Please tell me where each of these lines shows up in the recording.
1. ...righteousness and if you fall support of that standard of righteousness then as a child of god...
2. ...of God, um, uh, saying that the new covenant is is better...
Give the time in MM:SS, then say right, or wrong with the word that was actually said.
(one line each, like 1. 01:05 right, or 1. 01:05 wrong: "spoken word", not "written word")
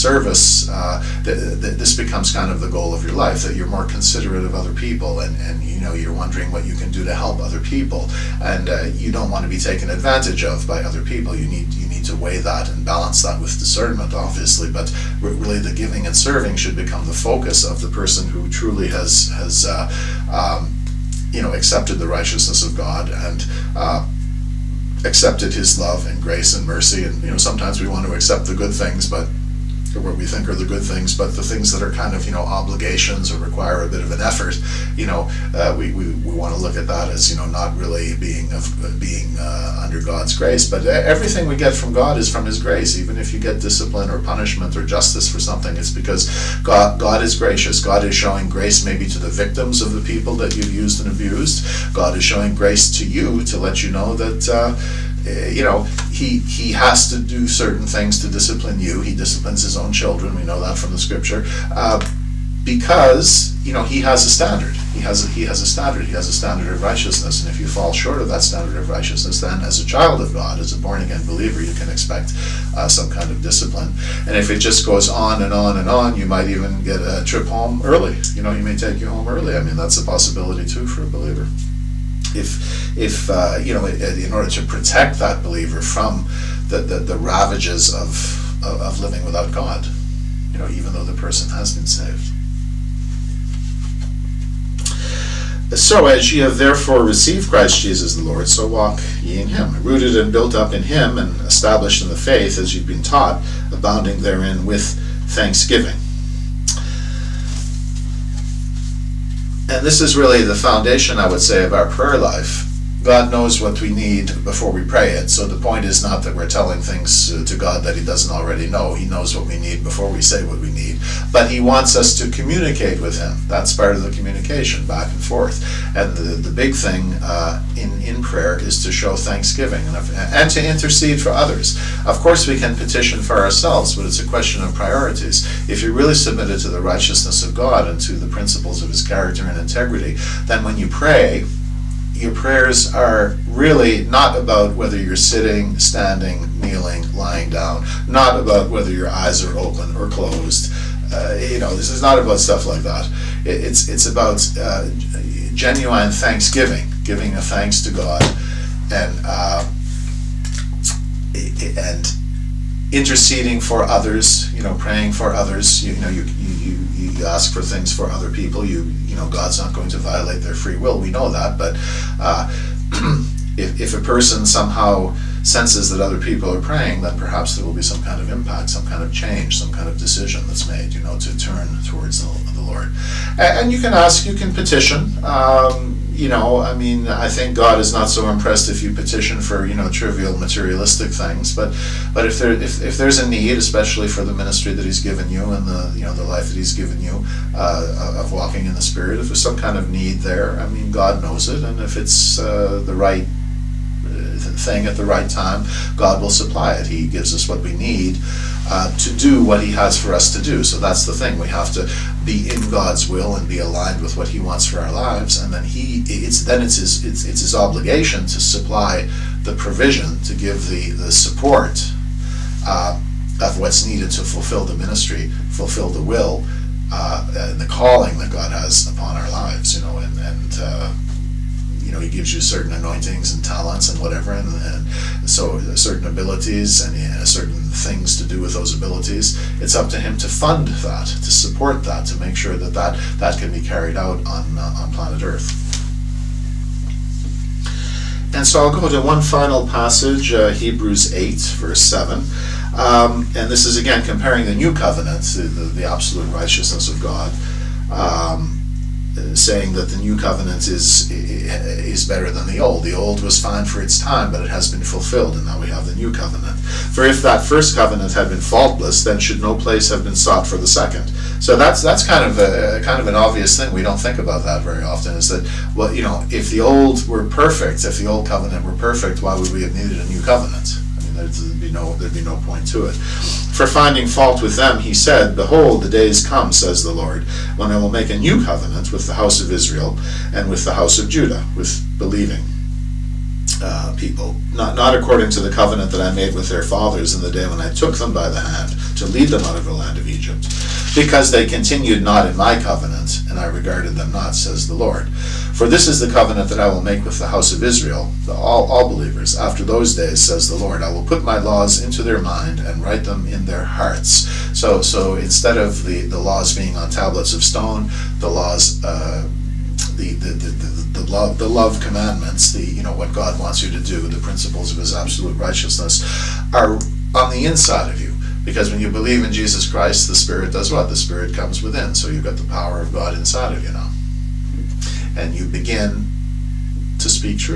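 1. 01:06 wrong: "short", not "support"
2. 04:16 right.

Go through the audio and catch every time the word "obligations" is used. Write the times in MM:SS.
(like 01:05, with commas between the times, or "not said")
00:32, 03:37.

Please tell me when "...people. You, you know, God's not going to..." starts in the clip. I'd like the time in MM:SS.
02:48.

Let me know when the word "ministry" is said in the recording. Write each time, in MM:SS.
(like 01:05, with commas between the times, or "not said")
03:14, 03:44.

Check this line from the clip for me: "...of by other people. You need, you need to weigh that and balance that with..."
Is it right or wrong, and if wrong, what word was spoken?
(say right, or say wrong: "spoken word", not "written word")
right.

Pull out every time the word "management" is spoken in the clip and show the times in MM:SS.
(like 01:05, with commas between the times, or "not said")
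not said.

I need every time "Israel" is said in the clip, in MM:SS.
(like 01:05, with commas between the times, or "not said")
04:49, 05:07.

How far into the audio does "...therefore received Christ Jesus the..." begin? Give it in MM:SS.
01:36.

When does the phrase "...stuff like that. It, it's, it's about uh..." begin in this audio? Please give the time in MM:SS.
02:32.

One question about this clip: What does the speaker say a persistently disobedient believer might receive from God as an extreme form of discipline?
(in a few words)
a trip home early.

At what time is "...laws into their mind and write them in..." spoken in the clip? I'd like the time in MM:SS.
05:11.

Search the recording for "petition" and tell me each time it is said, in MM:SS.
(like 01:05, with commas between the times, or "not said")
02:12, 03:04, 03:08.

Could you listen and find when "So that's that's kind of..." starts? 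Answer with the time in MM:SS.
04:31.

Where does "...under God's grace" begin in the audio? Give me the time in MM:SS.
00:39.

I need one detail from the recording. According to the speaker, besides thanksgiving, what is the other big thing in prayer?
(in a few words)
intercede for others.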